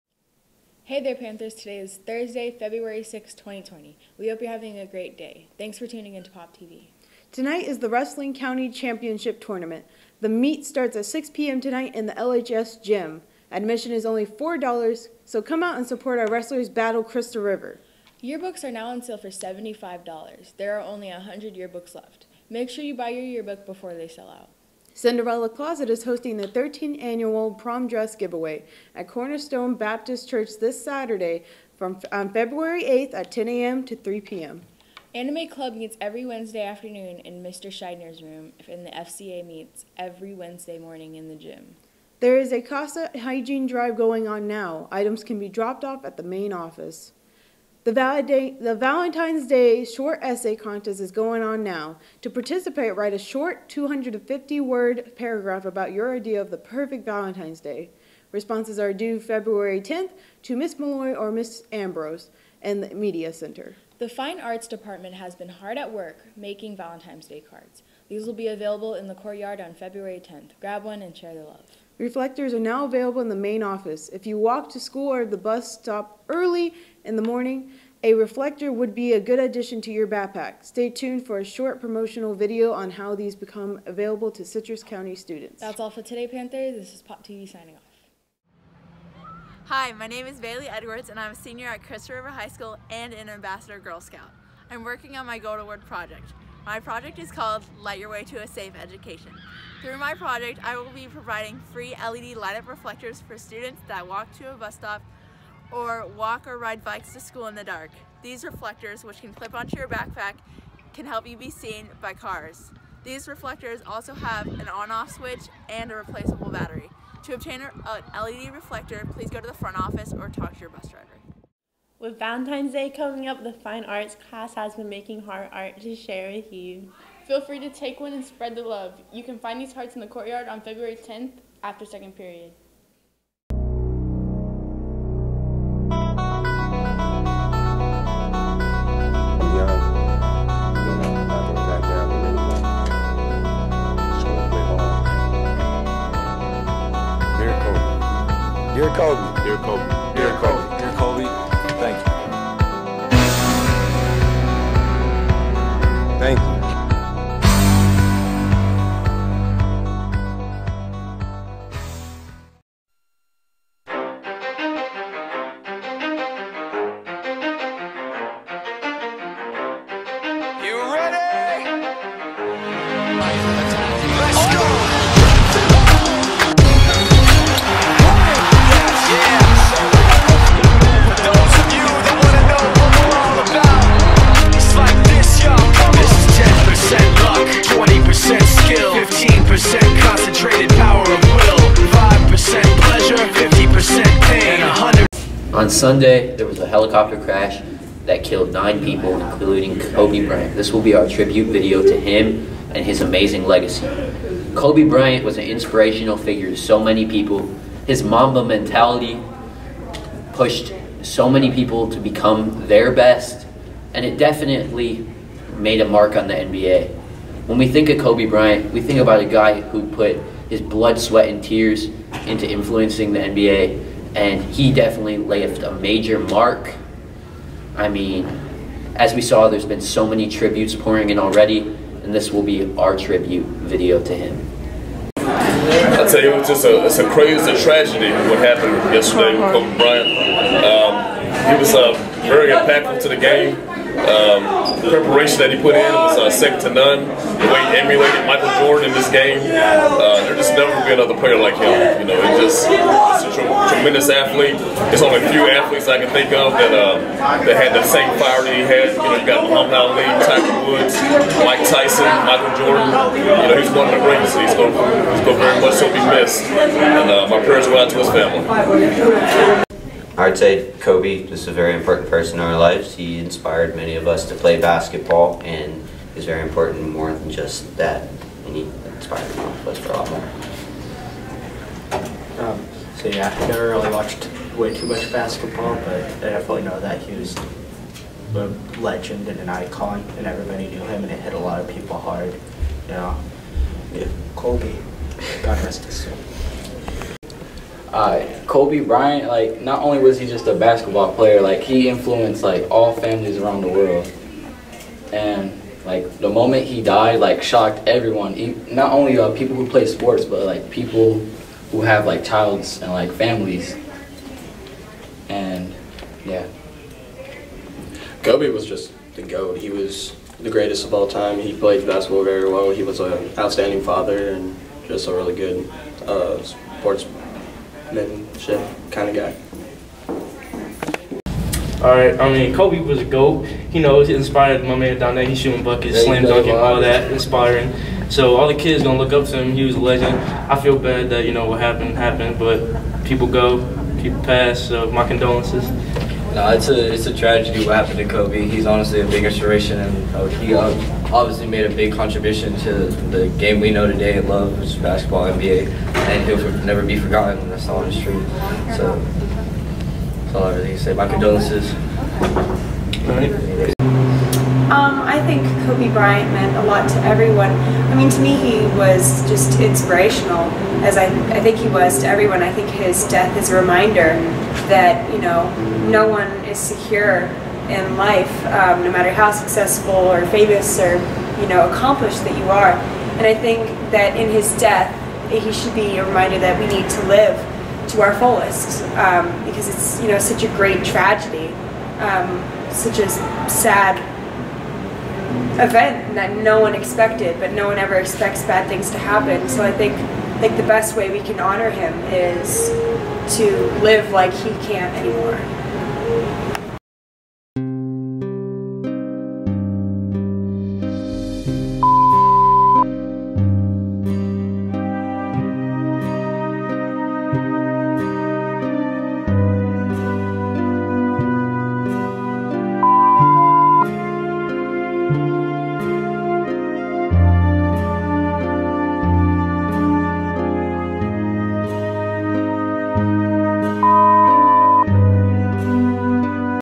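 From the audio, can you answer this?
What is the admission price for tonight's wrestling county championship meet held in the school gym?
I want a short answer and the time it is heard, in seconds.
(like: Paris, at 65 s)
$4, at 14 s.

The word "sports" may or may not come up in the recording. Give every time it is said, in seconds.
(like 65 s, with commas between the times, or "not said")
309 s, 326 s.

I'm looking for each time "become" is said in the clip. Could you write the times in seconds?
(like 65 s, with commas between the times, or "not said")
83 s, 211 s.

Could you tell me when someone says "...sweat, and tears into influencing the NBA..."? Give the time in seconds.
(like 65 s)
220 s.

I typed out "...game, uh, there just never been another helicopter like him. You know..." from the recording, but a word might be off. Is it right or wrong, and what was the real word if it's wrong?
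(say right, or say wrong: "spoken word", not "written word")
wrong: "player", not "helicopter".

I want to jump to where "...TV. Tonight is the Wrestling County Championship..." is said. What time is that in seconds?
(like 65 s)
6 s.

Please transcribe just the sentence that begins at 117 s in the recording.
To obtain an LED reflector, please go to the front office or talk to your bus driver.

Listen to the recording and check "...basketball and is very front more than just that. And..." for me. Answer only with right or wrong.
wrong.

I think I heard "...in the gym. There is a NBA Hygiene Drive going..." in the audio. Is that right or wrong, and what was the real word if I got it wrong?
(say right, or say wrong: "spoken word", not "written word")
wrong: "Casa", not "NBA".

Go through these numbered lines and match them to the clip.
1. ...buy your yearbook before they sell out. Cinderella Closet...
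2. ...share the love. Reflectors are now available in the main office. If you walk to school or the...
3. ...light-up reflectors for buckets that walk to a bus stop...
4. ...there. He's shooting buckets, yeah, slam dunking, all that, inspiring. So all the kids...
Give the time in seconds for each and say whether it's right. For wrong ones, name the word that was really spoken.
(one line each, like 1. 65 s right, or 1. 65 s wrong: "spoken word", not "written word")
1. 22 s right
2. 71 s right
3. 102 s wrong: "students", not "buckets"
4. 335 s right.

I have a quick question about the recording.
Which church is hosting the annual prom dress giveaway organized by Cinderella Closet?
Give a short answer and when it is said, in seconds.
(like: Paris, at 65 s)
Cornerstone Baptist Church, at 29 s.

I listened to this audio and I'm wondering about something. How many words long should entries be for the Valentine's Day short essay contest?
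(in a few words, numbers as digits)
250.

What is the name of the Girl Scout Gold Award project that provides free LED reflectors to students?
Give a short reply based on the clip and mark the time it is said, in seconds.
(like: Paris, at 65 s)
Light Your Way to a Safe Education, at 97 s.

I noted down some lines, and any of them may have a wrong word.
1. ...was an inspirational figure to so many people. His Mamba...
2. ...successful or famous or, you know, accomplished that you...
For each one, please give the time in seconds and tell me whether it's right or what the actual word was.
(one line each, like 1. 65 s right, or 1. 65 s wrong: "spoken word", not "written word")
1. 205 s right
2. 379 s right.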